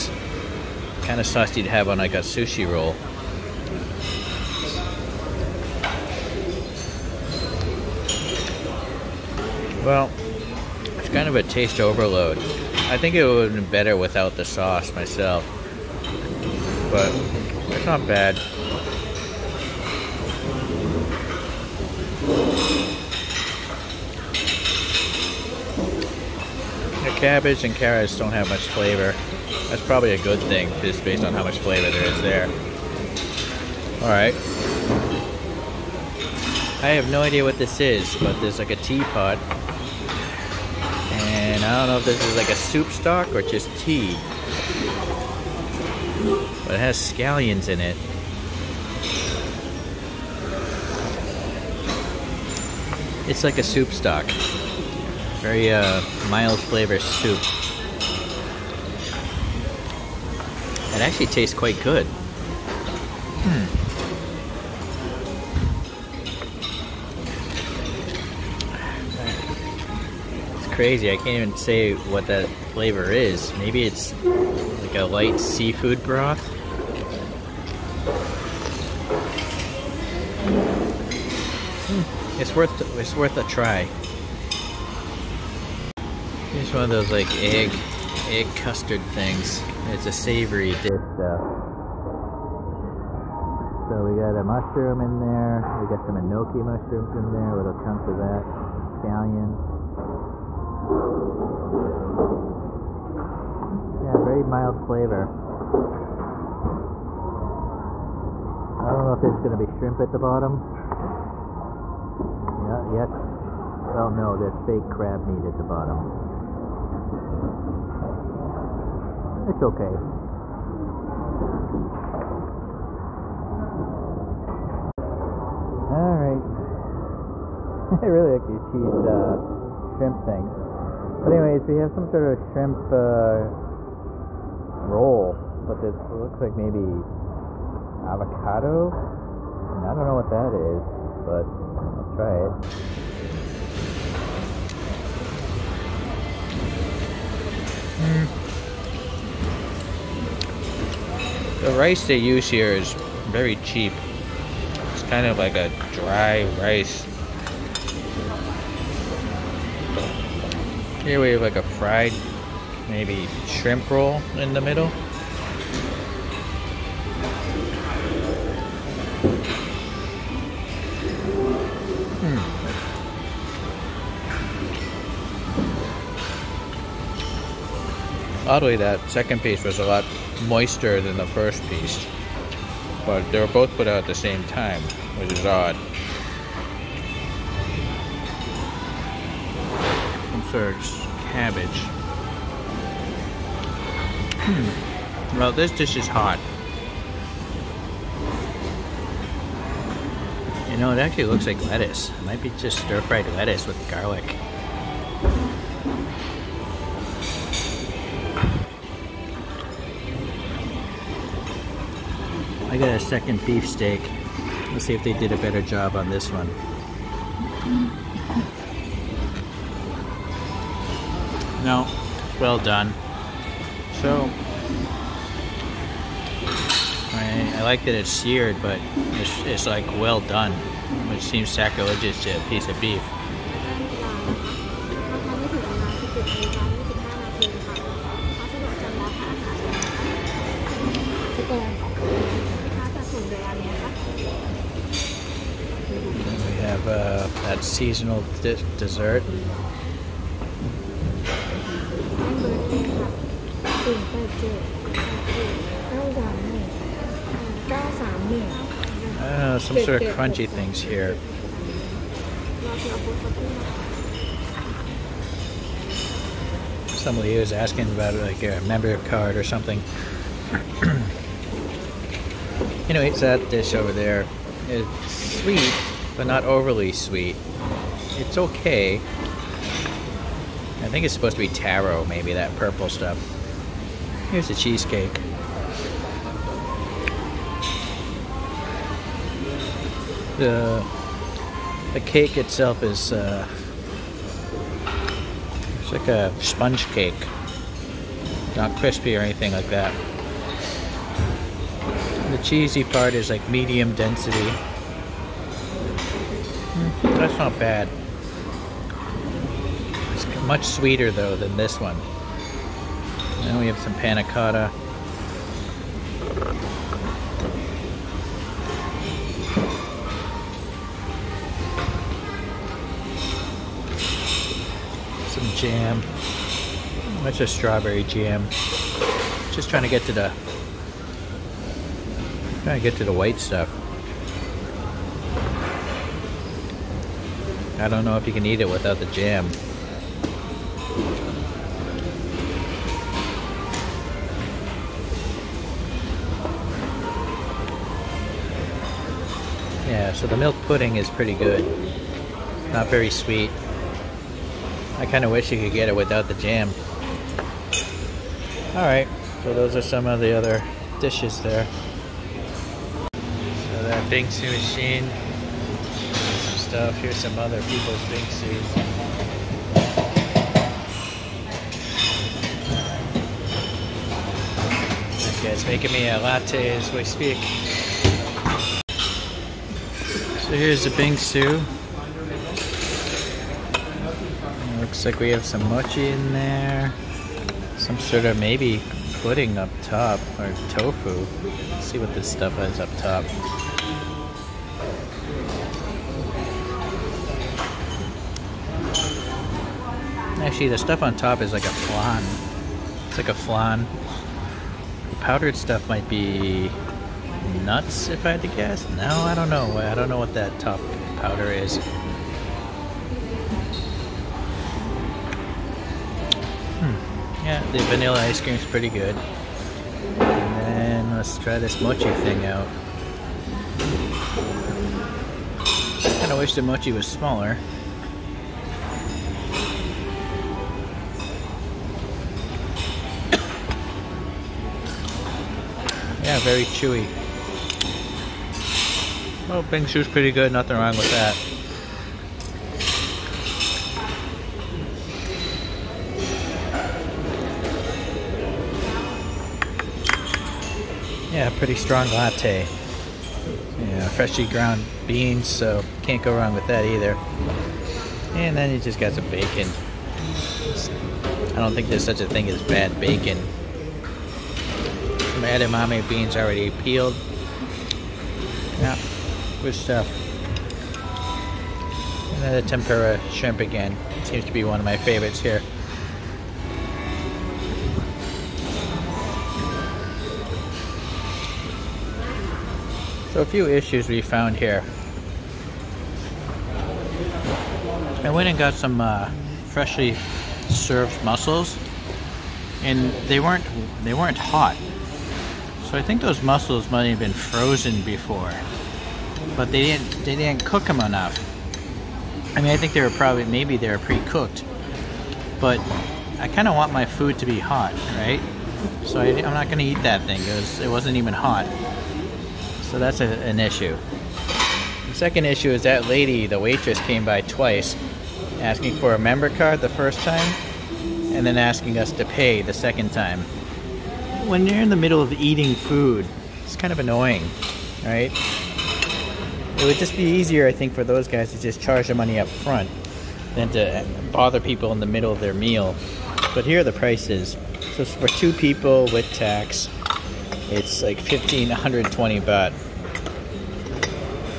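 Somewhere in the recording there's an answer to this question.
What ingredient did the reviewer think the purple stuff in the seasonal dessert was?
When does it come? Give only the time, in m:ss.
4:41.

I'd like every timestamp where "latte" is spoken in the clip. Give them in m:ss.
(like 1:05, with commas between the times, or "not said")
6:16, 7:32.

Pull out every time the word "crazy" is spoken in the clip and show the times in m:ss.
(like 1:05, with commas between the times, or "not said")
1:10.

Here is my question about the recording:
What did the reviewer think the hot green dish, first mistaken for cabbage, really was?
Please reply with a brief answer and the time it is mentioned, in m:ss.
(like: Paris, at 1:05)
stir-fried lettuce, at 3:22.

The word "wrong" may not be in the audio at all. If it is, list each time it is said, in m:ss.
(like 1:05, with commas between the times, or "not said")
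7:20, 7:36.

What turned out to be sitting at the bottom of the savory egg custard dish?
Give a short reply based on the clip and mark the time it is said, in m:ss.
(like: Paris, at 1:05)
fake crab meat, at 1:54.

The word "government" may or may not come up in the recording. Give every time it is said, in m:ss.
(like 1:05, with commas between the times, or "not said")
not said.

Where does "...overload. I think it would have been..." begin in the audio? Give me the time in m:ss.
0:11.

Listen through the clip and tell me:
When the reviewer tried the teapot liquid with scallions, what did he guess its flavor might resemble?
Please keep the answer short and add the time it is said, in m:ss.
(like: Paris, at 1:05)
light seafood broth, at 1:15.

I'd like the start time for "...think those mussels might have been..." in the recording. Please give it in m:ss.
8:16.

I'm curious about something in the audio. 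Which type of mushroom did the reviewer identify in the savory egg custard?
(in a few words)
enoki.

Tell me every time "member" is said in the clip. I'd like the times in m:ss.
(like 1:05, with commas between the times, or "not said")
4:28, 8:39.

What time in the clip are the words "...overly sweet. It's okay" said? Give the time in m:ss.
4:36.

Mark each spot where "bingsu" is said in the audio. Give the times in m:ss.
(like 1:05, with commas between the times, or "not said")
6:04, 6:20, 7:19.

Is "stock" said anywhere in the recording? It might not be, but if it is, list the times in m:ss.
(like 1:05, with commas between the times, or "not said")
0:42, 0:53.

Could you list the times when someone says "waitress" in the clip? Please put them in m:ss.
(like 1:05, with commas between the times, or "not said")
8:36.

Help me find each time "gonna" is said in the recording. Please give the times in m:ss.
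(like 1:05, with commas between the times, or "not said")
1:49, 8:29.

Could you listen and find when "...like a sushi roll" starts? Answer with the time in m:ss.
0:01.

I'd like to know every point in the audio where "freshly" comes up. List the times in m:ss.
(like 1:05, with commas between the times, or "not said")
7:34, 8:09.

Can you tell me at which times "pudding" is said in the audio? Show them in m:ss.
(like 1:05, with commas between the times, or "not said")
5:50, 6:29.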